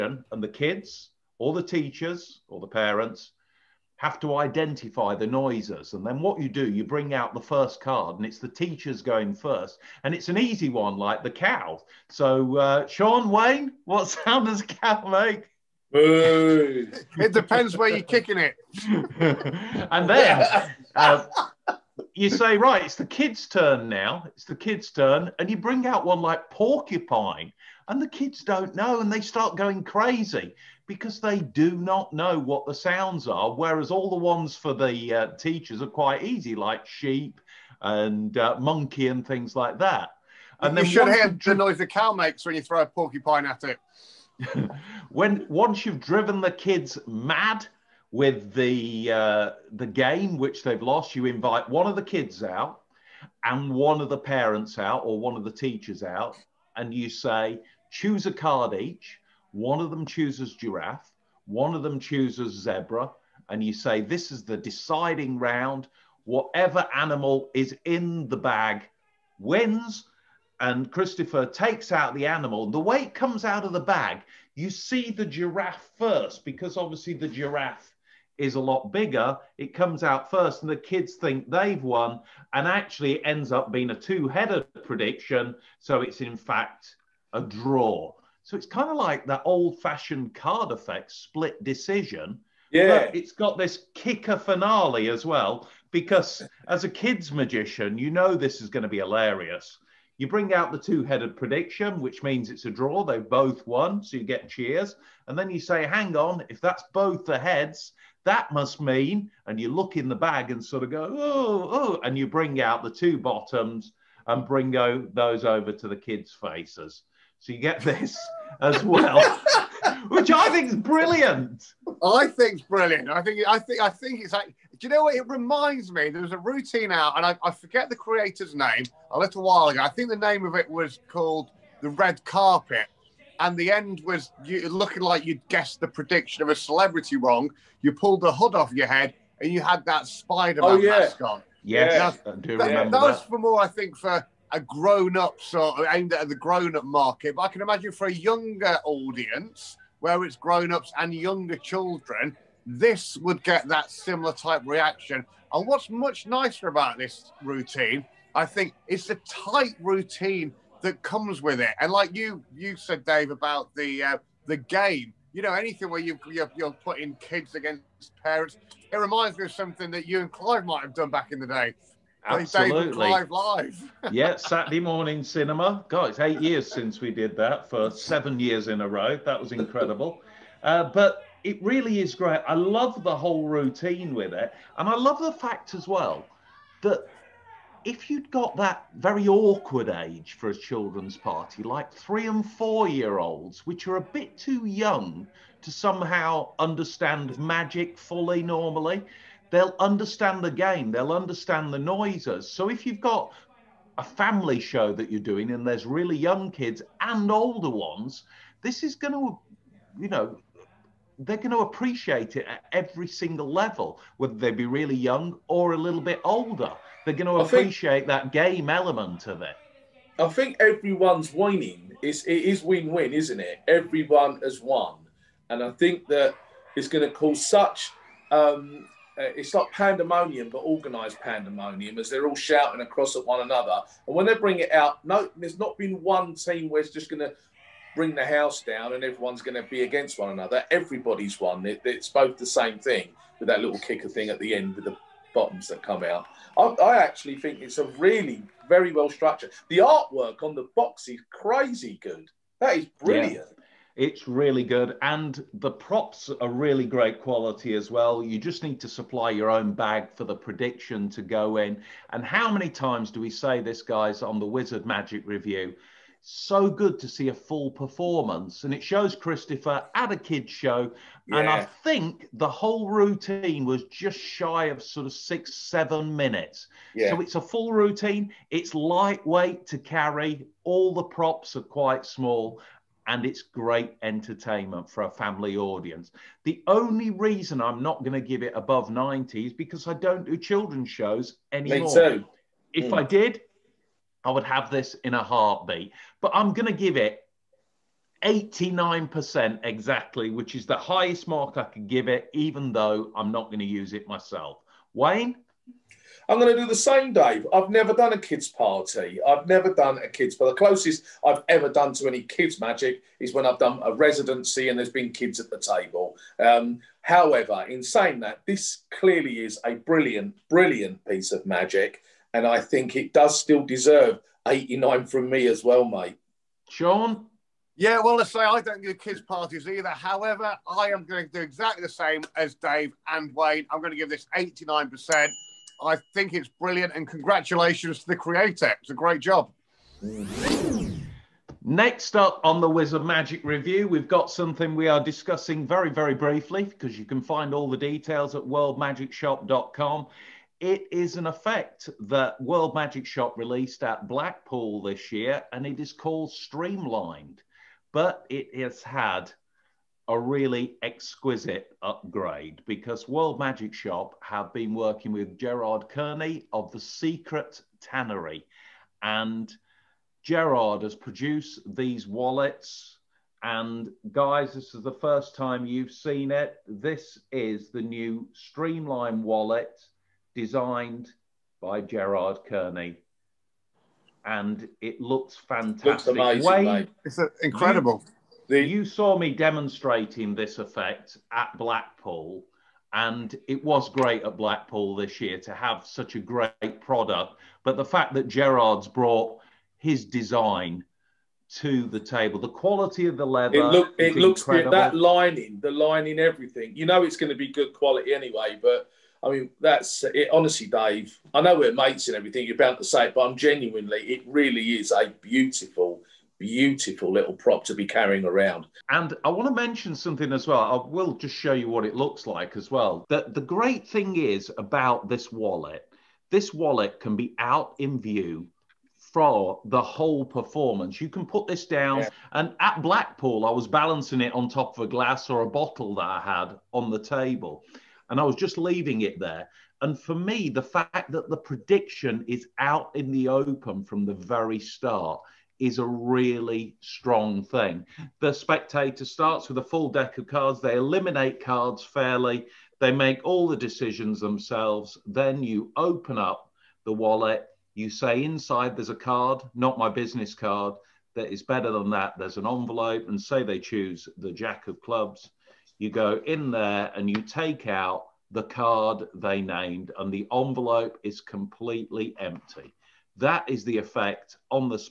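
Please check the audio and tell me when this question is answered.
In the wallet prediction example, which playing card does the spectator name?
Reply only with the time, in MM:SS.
07:44.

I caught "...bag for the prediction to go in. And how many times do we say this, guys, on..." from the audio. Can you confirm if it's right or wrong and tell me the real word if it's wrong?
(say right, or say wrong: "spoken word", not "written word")
right.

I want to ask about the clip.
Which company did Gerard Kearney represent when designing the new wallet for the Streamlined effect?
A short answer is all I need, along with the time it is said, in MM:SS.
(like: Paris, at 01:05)
The Secret Tannery, at 06:06.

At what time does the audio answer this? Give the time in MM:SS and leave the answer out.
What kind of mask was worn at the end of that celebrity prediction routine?
02:20.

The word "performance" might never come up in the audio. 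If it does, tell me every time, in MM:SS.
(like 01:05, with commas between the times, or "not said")
04:27, 07:10.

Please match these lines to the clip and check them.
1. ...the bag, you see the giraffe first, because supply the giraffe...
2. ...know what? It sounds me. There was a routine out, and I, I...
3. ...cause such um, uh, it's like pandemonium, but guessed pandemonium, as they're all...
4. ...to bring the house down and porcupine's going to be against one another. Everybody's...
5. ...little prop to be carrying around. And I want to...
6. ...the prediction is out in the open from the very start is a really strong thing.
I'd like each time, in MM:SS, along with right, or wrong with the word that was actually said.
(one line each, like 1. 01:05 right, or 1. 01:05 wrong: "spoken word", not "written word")
1. 01:13 wrong: "obviously", not "supply"
2. 02:04 wrong: "reminds", not "sounds"
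3. 03:47 wrong: "organised", not "guessed"
4. 03:57 wrong: "everyone", not "porcupine"
5. 06:57 right
6. 07:21 right.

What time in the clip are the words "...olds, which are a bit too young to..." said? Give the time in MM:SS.
03:13.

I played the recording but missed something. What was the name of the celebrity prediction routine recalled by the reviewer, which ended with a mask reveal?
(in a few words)
Red Carpet.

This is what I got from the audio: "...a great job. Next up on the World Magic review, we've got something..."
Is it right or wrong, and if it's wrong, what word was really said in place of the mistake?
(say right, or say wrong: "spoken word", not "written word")
wrong: "Wizard", not "World".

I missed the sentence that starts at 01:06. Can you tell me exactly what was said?
Whatever animal is in the bag wins.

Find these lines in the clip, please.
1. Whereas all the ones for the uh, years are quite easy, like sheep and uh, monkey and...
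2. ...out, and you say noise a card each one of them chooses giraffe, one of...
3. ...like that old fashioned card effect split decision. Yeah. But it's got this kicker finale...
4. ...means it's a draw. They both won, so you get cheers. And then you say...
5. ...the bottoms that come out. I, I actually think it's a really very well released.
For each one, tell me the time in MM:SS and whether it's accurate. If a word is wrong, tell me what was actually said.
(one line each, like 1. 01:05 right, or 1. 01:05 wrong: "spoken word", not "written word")
1. 00:33 wrong: "teachers", not "years"
2. 00:56 wrong: "choose", not "noise"
3. 01:28 right
4. 01:42 right
5. 04:04 wrong: "structured", not "released".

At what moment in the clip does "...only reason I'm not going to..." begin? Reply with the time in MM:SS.
04:46.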